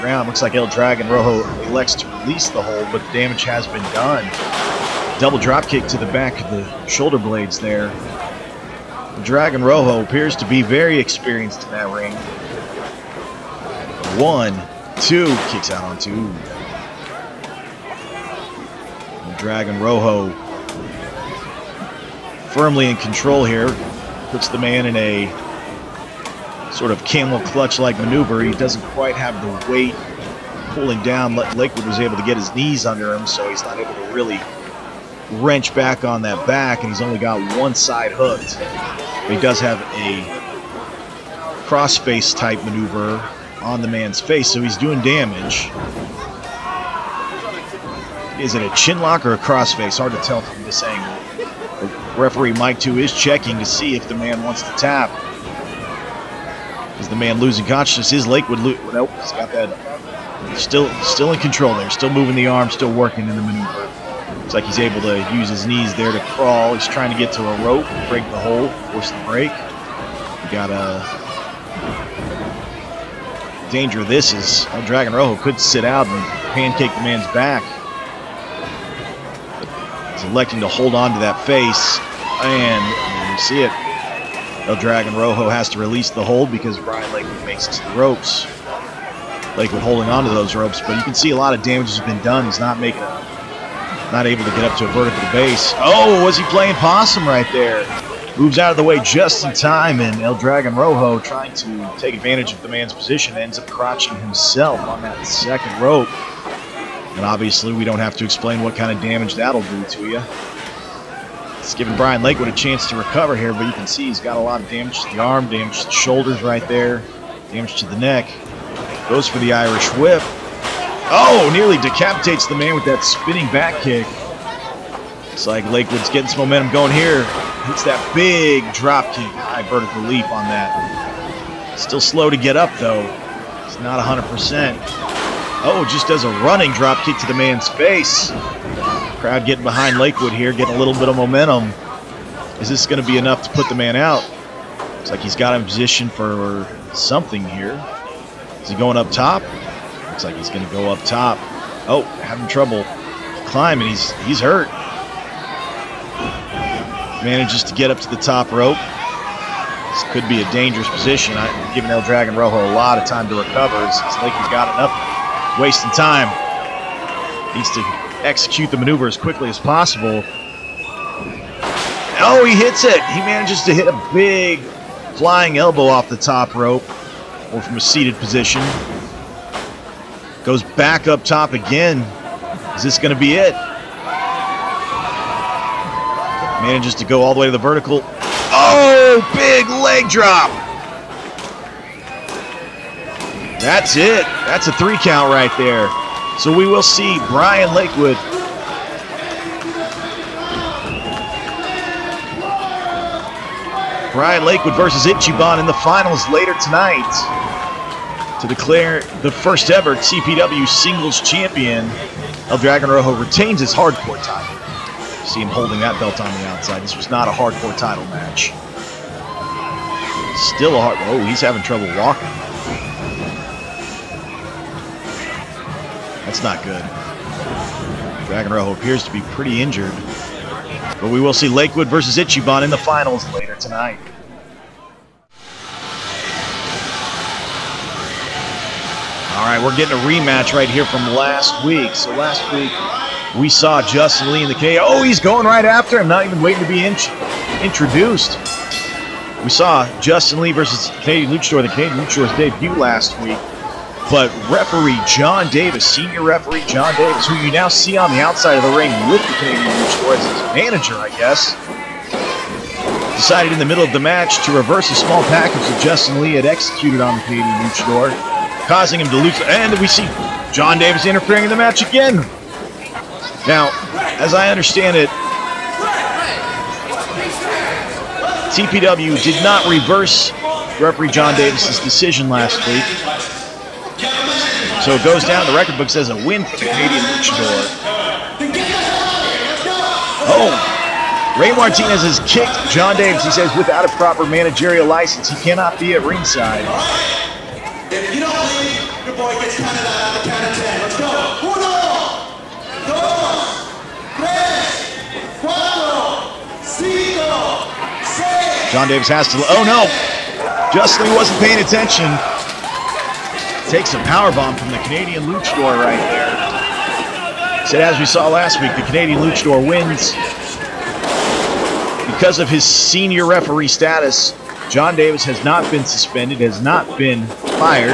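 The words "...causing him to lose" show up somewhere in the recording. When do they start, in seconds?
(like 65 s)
268 s.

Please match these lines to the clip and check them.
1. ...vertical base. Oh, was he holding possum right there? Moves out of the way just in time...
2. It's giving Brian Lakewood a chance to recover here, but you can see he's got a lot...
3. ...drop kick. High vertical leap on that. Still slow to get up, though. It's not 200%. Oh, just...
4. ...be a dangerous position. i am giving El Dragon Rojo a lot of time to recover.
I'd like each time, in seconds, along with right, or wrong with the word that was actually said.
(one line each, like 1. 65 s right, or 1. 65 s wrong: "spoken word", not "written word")
1. 94 s wrong: "playing", not "holding"
2. 111 s right
3. 128 s wrong: "100", not "200"
4. 160 s right.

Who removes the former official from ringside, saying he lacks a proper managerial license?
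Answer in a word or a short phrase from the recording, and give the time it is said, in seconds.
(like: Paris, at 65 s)
Ray Martinez, at 291 s.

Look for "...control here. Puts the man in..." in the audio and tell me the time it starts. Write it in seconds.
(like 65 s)
22 s.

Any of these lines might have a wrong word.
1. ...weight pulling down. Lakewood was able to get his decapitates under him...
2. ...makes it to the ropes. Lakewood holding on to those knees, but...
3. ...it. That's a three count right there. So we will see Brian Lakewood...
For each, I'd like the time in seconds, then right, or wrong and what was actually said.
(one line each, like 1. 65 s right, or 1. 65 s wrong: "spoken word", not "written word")
1. 29 s wrong: "knees", not "decapitates"
2. 87 s wrong: "ropes", not "knees"
3. 193 s right.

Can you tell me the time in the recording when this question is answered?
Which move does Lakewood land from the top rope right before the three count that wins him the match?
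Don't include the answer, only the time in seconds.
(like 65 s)
189 s.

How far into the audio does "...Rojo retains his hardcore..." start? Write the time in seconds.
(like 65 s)
212 s.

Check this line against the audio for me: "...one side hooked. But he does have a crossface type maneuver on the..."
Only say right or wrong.
right.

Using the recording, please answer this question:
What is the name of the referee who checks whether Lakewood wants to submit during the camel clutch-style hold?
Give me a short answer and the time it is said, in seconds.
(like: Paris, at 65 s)
Mike 2, at 52 s.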